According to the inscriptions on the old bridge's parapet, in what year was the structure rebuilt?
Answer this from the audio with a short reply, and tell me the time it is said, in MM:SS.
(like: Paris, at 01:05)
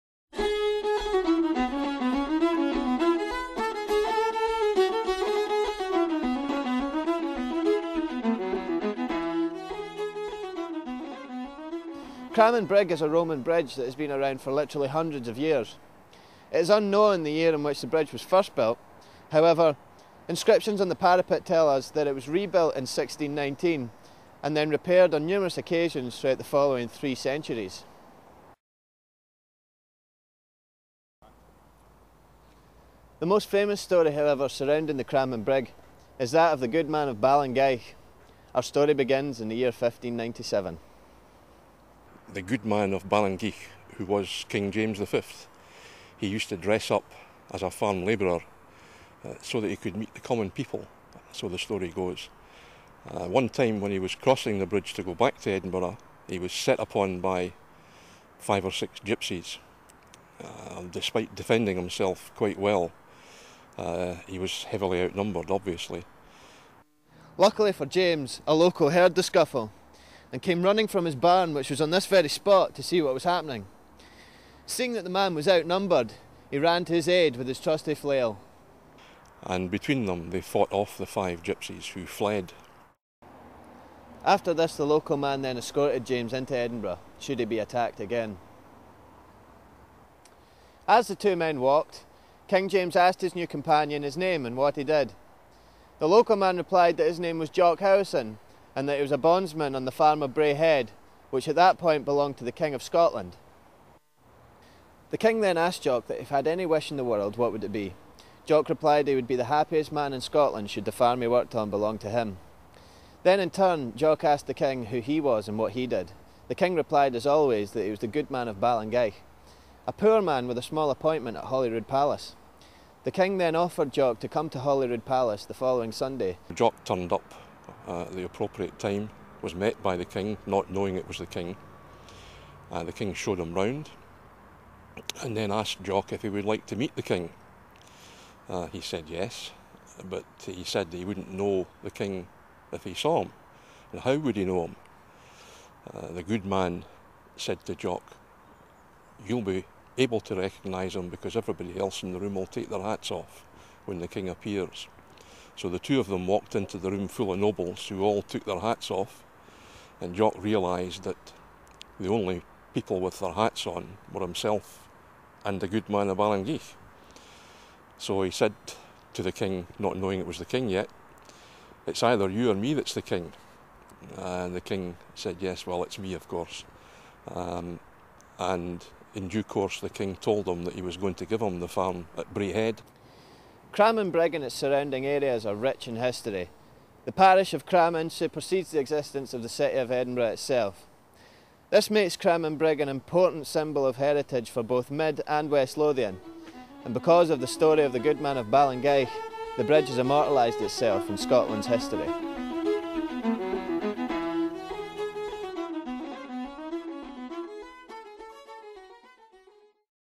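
1619, at 00:22.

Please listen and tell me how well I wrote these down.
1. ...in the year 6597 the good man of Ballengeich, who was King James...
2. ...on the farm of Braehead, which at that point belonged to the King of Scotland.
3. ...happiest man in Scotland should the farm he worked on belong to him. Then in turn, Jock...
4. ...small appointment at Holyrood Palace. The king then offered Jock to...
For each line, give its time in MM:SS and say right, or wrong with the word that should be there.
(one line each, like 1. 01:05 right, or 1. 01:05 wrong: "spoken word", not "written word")
1. 00:39 wrong: "1597", not "6597"
2. 01:39 right
3. 01:49 right
4. 02:00 right.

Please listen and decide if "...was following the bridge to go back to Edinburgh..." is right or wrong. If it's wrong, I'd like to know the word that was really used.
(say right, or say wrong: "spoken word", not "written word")
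wrong: "crossing", not "following".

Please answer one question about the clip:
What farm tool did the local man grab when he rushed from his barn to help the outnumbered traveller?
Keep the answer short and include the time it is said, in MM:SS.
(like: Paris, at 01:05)
Flail, at 01:17.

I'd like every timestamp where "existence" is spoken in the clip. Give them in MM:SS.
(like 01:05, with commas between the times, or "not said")
03:08.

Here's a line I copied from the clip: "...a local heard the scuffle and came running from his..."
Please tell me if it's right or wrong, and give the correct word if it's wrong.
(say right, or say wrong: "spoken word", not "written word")
right.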